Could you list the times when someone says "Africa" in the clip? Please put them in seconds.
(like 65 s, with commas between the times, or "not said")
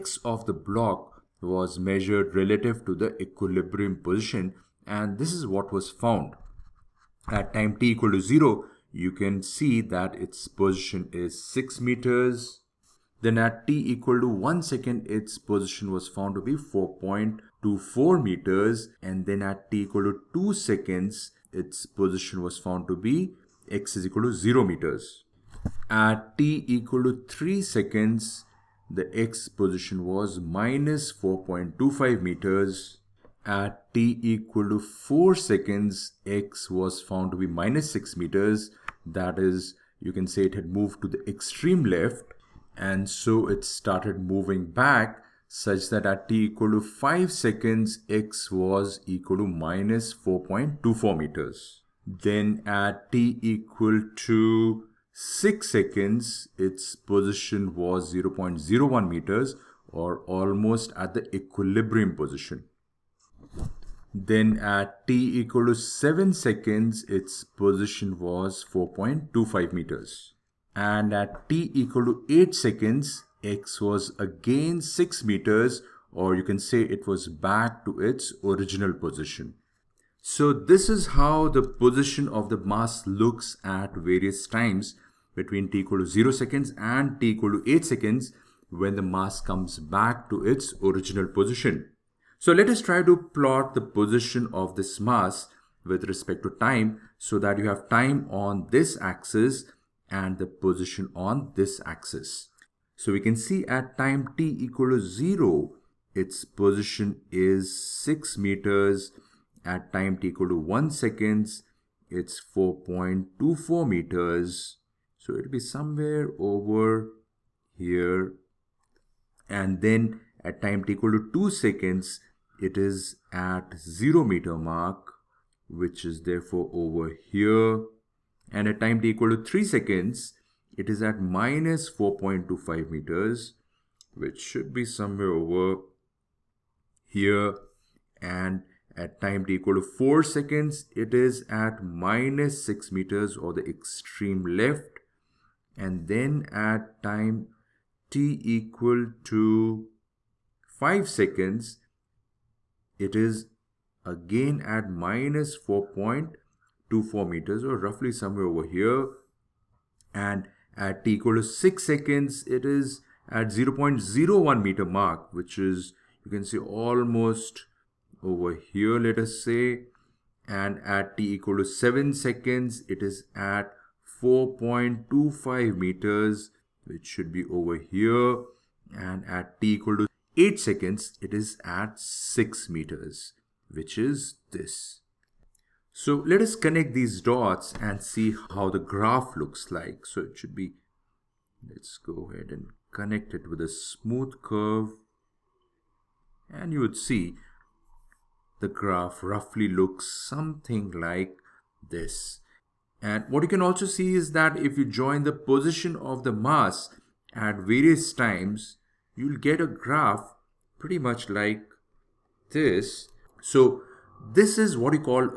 not said.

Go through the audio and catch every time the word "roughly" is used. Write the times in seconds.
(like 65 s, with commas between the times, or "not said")
157 s, 199 s.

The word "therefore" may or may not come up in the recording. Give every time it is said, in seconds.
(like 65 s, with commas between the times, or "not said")
126 s.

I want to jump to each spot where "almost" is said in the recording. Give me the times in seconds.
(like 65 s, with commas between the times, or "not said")
60 s, 166 s.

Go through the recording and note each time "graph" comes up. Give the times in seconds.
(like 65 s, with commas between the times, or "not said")
188 s, 198 s, 209 s.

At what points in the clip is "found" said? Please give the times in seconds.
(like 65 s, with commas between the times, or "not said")
5 s, 16 s, 22 s, 37 s.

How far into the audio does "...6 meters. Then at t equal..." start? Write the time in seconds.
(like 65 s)
11 s.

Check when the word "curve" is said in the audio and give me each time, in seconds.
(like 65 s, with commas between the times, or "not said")
194 s.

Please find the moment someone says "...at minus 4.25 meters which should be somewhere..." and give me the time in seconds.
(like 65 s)
131 s.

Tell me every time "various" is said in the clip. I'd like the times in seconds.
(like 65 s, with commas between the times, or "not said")
83 s, 207 s.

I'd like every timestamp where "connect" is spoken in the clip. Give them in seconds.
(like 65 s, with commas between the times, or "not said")
186 s, 192 s.